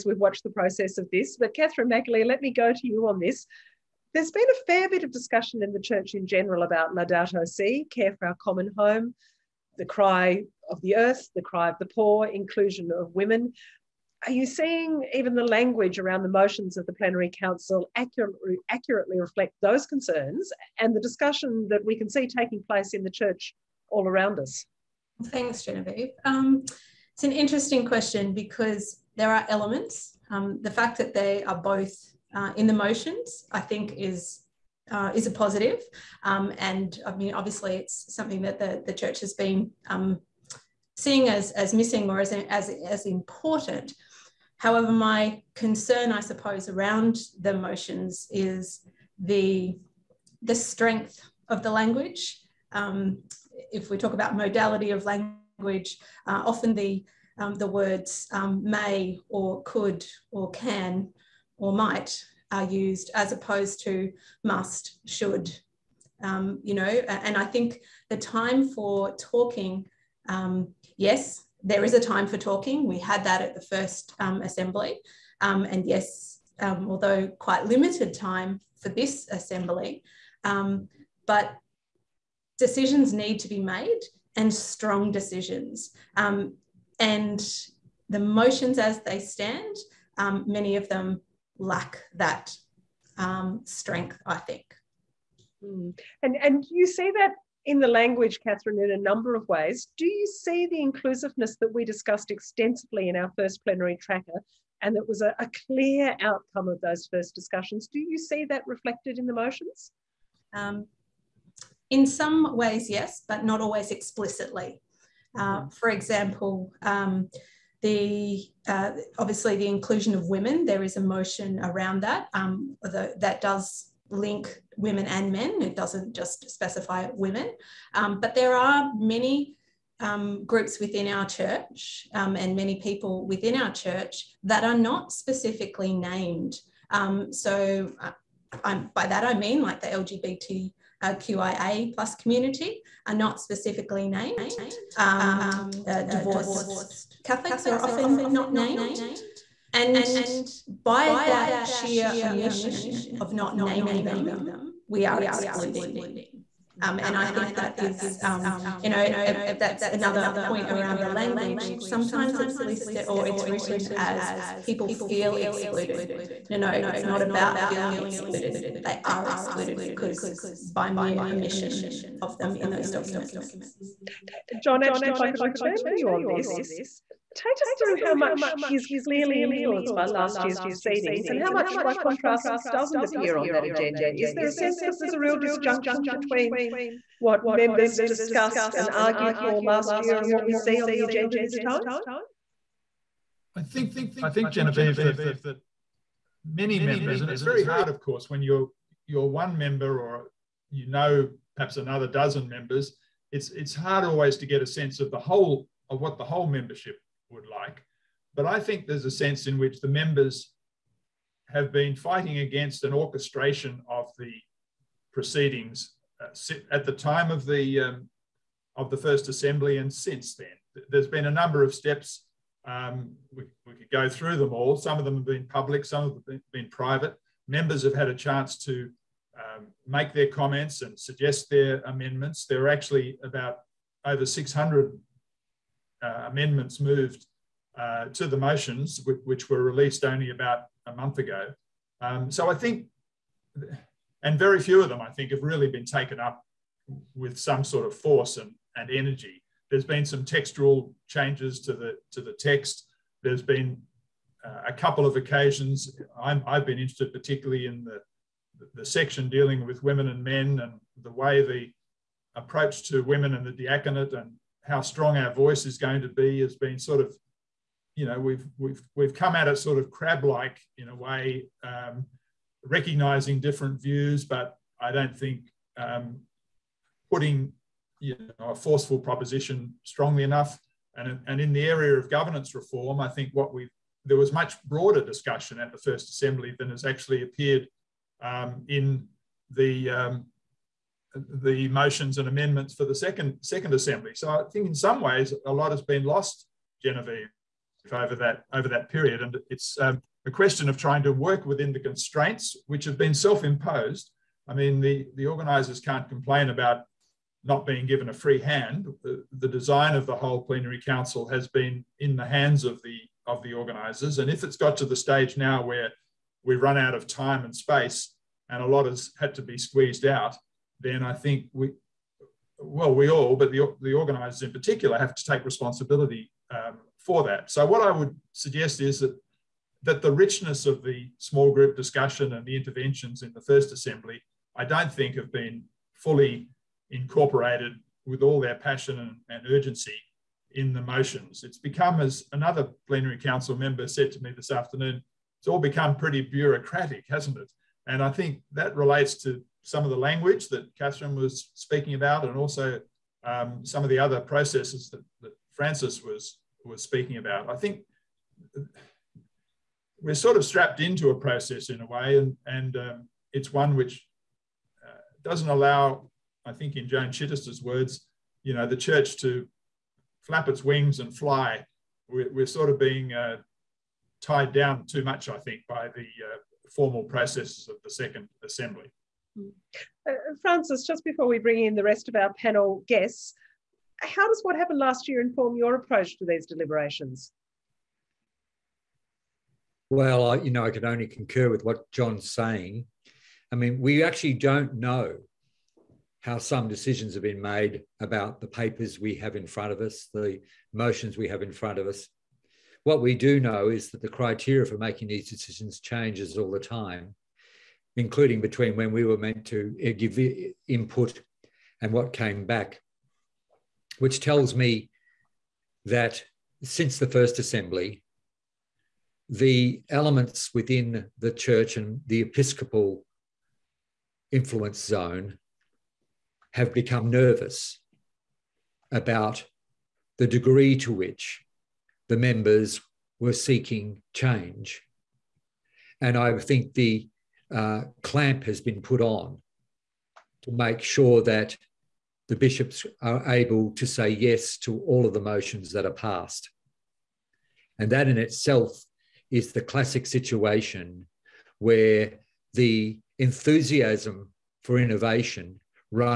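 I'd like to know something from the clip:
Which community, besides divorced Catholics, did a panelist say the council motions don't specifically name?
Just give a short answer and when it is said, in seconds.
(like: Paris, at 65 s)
LGBTQIA plus community, at 139 s.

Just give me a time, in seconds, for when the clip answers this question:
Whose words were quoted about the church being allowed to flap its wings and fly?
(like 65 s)
366 s.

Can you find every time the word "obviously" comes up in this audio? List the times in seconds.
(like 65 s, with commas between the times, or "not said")
37 s, 119 s.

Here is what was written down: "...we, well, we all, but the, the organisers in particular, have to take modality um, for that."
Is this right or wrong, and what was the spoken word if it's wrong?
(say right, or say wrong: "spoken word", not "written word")
wrong: "responsibility", not "modality".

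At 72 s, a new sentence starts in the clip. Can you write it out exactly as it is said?
We had that at the first um, assembly.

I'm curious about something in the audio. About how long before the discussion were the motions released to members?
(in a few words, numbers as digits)
about a month ago.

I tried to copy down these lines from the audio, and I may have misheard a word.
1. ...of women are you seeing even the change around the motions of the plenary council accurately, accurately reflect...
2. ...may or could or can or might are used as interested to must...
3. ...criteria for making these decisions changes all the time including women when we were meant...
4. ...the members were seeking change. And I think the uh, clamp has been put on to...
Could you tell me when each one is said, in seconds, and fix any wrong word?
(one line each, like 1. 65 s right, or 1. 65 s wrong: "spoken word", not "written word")
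1. 12 s wrong: "language", not "change"
2. 58 s wrong: "opposed", not "interested"
3. 404 s wrong: "between", not "women"
4. 432 s right.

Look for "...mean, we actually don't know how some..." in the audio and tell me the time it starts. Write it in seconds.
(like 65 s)
393 s.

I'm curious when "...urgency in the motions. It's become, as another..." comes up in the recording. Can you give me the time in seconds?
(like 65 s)
339 s.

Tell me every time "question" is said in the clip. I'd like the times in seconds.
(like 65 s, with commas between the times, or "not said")
27 s, 300 s.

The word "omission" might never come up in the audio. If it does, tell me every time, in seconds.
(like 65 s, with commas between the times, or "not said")
152 s, 171 s.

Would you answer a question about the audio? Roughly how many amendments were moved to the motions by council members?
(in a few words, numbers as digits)
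over 600.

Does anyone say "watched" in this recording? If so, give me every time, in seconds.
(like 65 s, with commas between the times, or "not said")
0 s.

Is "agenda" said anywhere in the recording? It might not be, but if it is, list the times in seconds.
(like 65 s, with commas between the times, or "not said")
183 s, 191 s.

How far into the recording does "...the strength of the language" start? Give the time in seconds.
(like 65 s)
50 s.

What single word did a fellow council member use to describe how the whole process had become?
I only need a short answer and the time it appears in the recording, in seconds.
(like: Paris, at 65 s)
bureaucratic, at 346 s.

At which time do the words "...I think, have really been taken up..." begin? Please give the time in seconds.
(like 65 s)
245 s.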